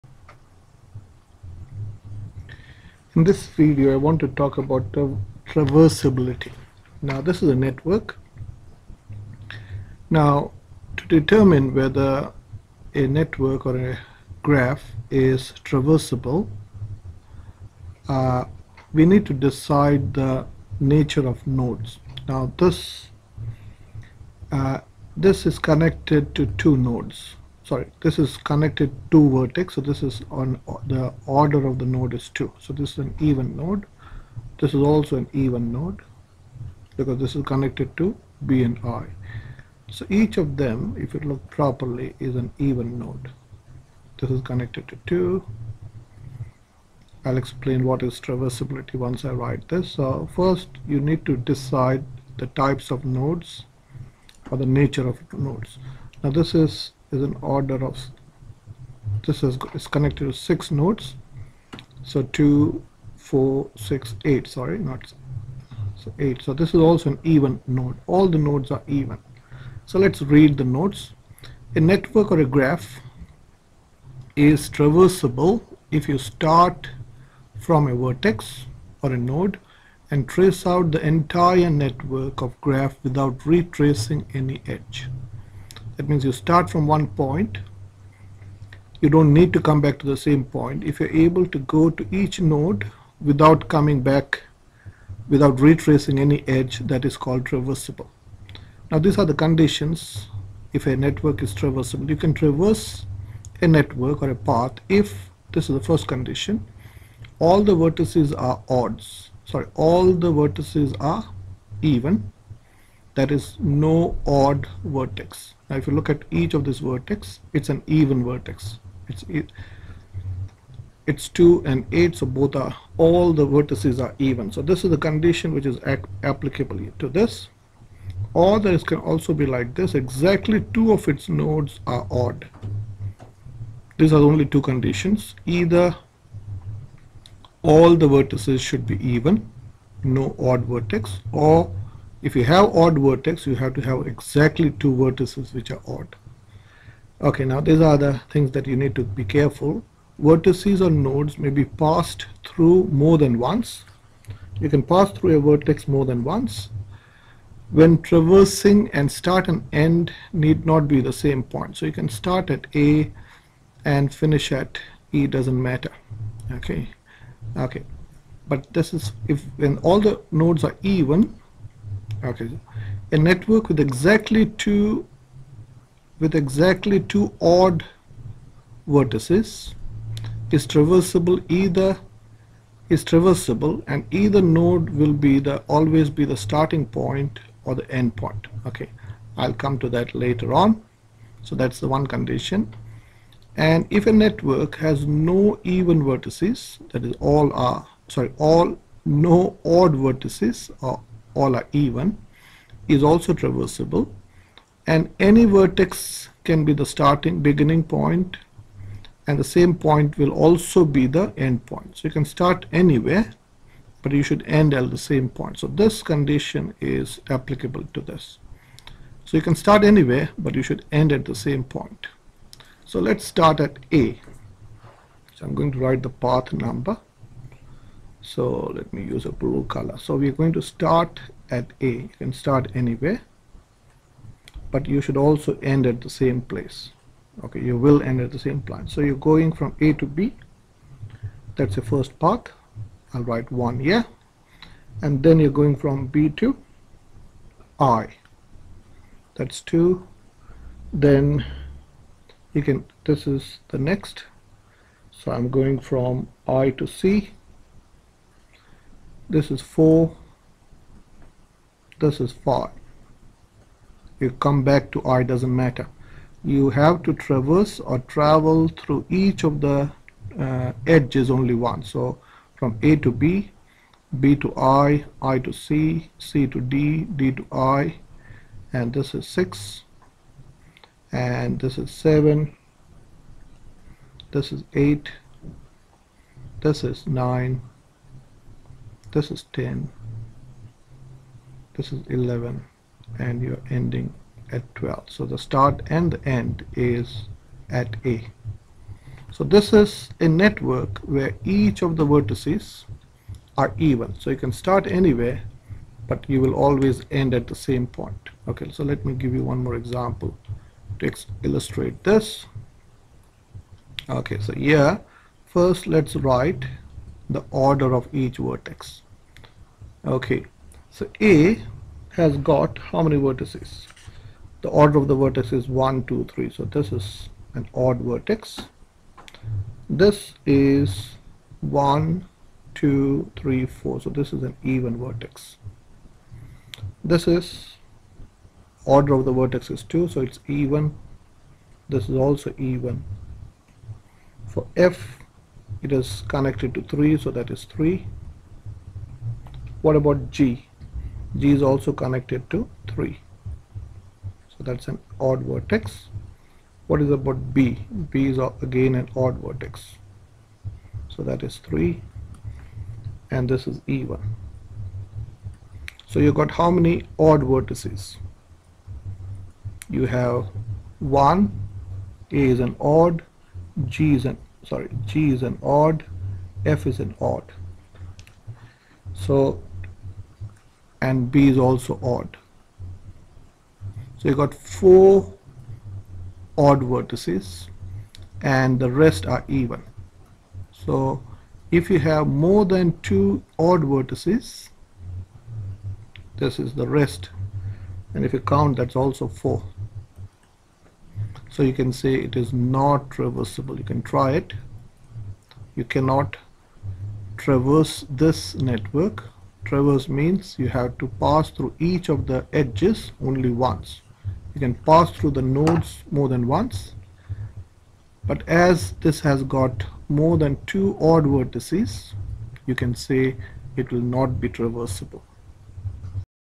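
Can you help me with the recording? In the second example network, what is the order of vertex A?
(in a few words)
3.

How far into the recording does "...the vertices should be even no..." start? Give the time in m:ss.
2:17.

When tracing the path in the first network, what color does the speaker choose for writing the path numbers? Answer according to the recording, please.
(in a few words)
Blue.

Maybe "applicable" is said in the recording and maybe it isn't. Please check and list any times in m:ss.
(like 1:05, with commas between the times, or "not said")
2:06, 3:37.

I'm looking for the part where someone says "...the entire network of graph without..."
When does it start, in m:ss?
1:20.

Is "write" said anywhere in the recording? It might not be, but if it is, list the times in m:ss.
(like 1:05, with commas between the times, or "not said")
0:49, 3:45, 4:03, 5:16.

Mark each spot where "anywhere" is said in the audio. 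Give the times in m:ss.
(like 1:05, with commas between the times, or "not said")
3:32, 3:39, 3:52, 5:04.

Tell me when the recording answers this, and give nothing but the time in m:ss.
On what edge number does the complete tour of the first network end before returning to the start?
4:54.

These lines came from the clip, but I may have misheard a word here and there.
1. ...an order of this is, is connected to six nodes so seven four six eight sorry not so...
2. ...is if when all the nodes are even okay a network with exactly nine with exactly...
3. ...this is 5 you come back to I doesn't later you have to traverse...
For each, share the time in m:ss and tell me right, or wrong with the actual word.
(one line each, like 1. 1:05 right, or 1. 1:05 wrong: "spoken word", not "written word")
1. 0:57 wrong: "two", not "seven"
2. 2:48 wrong: "two", not "nine"
3. 4:21 wrong: "matter", not "later".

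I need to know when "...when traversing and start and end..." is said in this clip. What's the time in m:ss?
2:37.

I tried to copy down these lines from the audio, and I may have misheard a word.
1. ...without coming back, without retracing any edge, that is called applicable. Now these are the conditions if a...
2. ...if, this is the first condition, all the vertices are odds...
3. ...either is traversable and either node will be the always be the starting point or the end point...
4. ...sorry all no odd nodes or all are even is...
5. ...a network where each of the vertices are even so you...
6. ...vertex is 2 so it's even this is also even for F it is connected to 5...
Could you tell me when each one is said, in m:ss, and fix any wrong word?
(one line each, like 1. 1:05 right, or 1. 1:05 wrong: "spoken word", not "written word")
1. 1:33 wrong: "traversable", not "applicable"
2. 1:44 right
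3. 3:01 right
4. 3:18 wrong: "vertices", not "nodes"
5. 5:00 right
6. 5:39 wrong: "3", not "5".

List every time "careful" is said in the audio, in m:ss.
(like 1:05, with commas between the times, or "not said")
2:29.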